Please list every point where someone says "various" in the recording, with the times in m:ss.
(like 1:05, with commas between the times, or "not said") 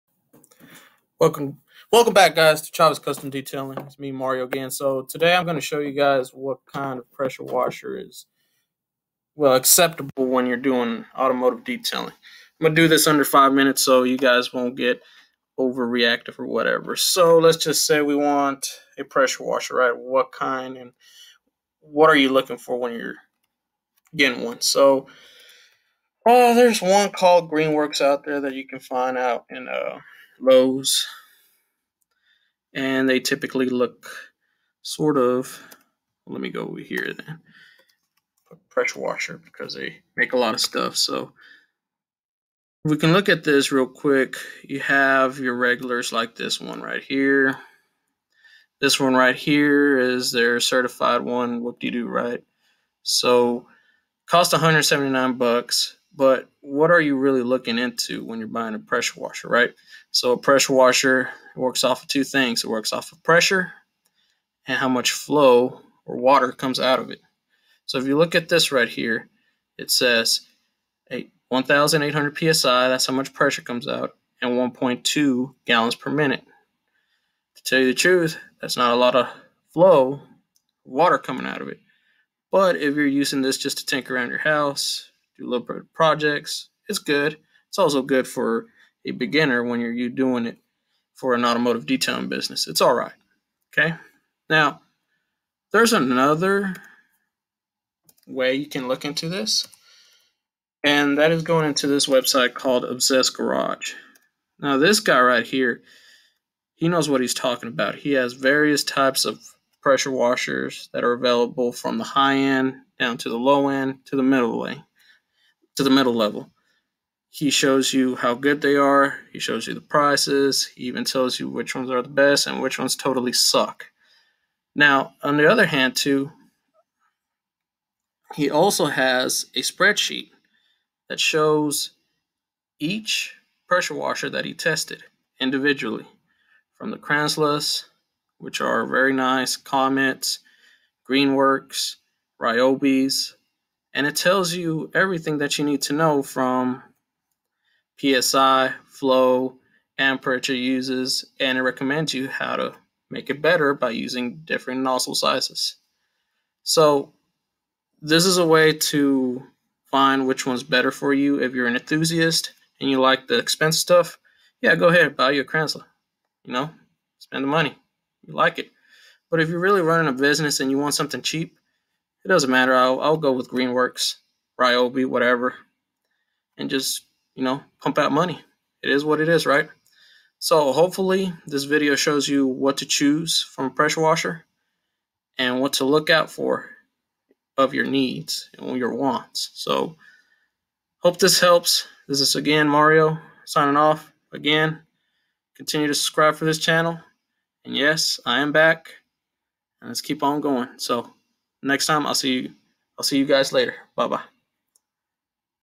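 1:48.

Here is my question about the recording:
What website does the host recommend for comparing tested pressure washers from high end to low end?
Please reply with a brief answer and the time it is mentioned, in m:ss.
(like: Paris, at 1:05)
Obsessed Garage, at 1:42.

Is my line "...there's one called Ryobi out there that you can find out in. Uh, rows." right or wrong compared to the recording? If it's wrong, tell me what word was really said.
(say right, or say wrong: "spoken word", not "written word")
wrong: "Greenworks", not "Ryobi".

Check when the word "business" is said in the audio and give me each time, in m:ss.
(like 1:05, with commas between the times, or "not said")
1:32, 2:50.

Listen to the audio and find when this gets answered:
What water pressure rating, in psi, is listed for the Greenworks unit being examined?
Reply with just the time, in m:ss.
1:11.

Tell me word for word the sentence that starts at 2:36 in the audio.
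So this is a way to find which one's better for you.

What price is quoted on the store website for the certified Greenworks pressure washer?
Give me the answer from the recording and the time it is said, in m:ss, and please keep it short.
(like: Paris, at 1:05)
$179, at 0:54.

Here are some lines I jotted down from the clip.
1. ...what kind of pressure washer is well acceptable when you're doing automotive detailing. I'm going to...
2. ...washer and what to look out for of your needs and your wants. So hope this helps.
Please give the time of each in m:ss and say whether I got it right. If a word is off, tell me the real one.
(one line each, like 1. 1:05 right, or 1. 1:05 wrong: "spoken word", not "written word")
1. 0:06 right
2. 3:04 right.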